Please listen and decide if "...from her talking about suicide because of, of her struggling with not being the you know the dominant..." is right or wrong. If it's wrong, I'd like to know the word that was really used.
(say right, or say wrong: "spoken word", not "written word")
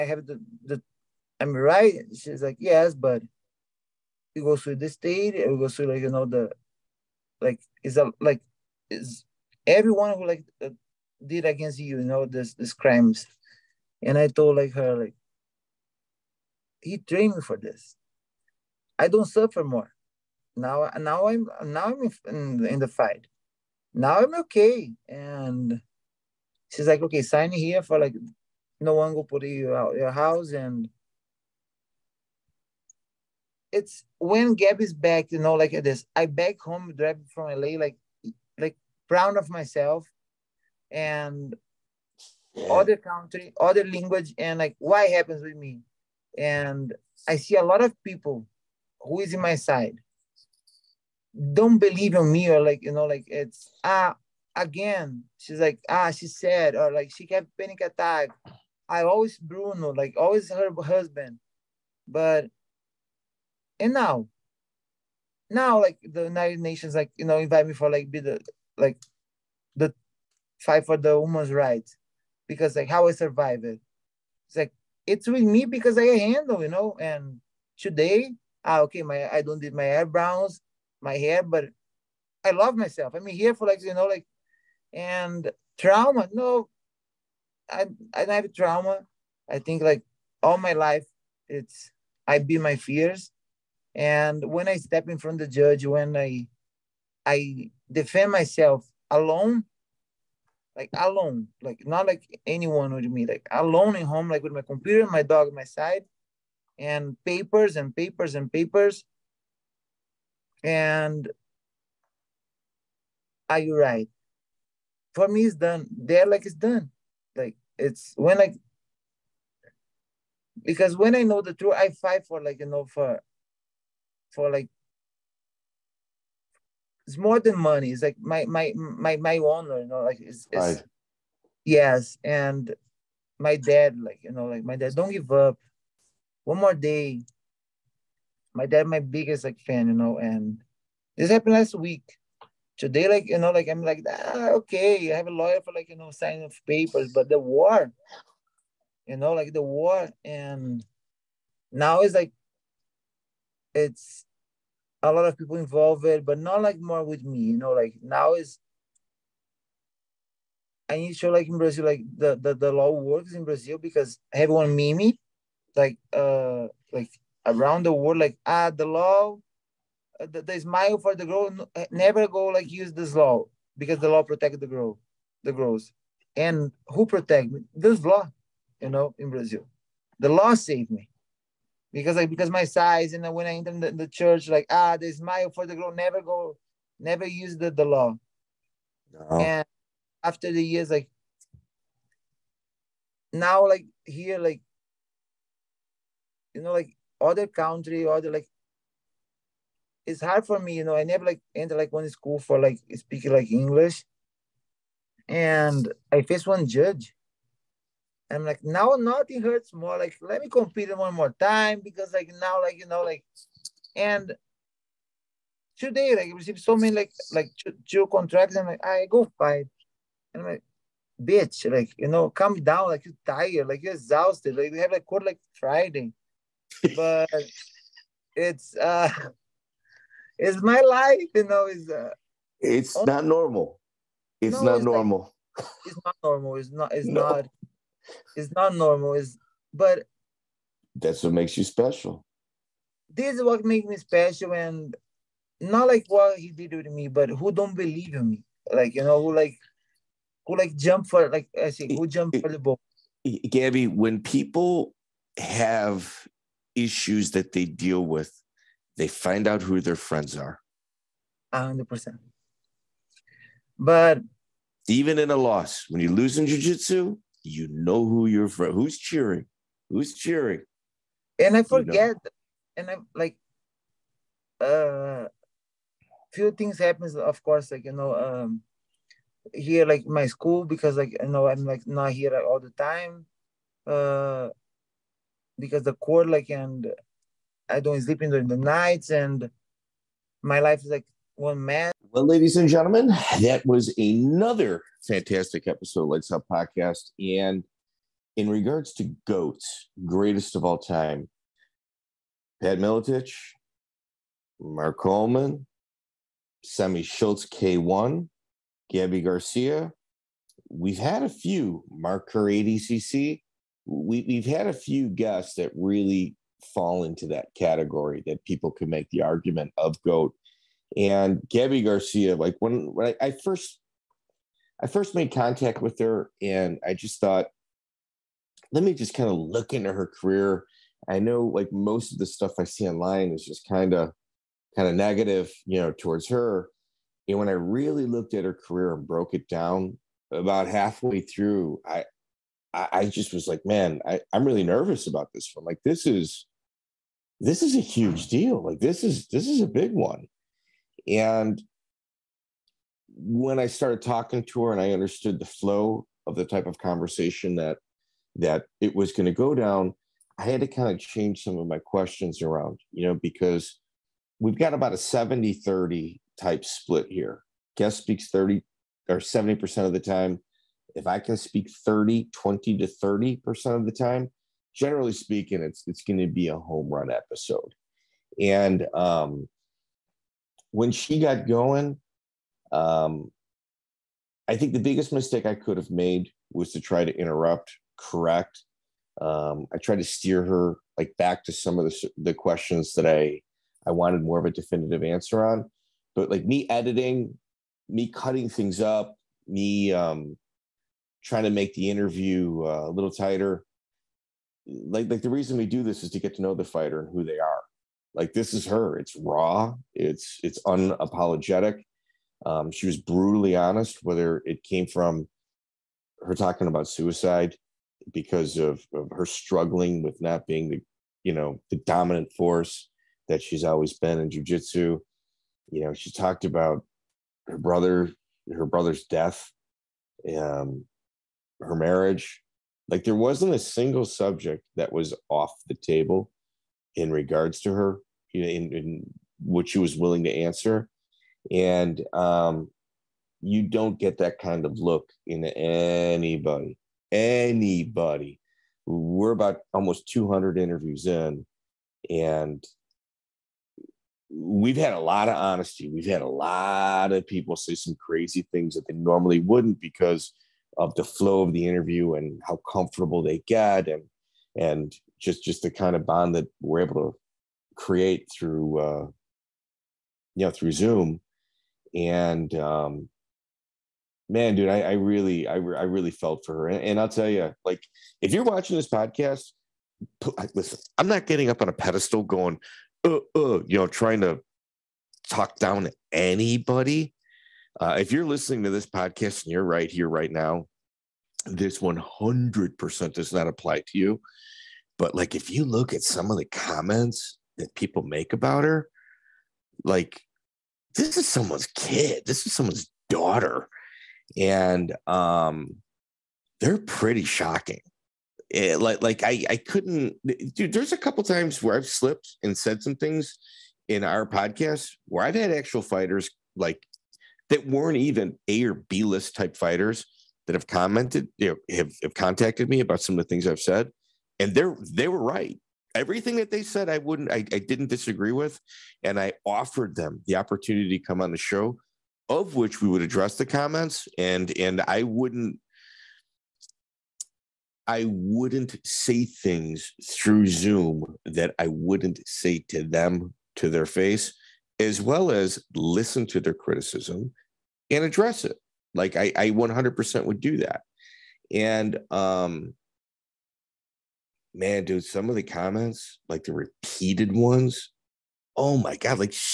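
right.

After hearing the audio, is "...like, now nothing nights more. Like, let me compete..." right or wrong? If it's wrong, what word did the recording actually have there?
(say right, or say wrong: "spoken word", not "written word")
wrong: "hurts", not "nights".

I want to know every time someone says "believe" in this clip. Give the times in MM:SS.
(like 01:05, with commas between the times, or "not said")
00:51, 04:07.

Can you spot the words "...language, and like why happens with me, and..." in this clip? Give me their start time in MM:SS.
00:43.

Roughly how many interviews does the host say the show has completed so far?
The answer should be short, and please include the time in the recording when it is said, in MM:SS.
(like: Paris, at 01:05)
200, at 07:30.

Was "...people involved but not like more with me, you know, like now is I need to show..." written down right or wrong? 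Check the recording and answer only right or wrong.
right.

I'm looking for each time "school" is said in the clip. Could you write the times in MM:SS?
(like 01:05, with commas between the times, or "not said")
03:22, 04:40.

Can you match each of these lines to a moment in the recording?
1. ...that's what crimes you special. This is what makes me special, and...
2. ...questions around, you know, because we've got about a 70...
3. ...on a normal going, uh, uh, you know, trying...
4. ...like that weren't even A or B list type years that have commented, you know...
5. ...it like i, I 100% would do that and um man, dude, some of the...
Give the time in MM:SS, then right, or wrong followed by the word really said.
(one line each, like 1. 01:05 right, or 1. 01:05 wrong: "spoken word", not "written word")
1. 04:00 wrong: "makes", not "crimes"
2. 06:01 right
3. 08:01 wrong: "pedestal", not "normal"
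4. 08:36 wrong: "fighters", not "years"
5. 09:08 right.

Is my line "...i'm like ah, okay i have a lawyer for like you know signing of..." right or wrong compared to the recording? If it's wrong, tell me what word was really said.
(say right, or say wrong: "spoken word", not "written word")
right.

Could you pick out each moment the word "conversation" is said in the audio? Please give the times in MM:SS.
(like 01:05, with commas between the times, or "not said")
05:56.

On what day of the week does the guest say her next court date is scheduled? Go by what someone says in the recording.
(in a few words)
Friday.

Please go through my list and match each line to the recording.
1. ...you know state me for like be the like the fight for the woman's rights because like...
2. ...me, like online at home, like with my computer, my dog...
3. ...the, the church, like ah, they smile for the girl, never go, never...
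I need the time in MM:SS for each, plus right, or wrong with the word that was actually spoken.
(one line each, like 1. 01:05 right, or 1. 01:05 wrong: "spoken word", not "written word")
1. 01:07 wrong: "invite", not "state"
2. 01:43 wrong: "alone", not "online"
3. 03:03 right.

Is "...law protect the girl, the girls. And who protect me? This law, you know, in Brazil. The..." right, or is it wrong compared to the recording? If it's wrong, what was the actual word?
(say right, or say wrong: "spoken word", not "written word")
right.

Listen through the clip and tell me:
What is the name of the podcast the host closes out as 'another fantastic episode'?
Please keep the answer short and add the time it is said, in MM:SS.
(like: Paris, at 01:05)
Lytes Out Podcast, at 04:56.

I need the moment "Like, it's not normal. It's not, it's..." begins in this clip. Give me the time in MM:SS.
03:55.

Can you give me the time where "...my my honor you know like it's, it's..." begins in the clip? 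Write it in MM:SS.
02:08.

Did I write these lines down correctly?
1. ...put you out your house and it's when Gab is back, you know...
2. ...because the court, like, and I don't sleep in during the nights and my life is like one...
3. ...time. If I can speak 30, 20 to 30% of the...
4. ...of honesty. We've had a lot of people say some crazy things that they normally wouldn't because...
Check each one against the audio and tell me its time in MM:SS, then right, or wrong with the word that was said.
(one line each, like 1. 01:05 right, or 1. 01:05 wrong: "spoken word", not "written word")
1. 00:29 right
2. 04:45 right
3. 06:09 right
4. 07:35 right.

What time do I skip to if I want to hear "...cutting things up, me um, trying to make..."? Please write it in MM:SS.
06:38.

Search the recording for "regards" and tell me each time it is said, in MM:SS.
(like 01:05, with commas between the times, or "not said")
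04:58, 07:17.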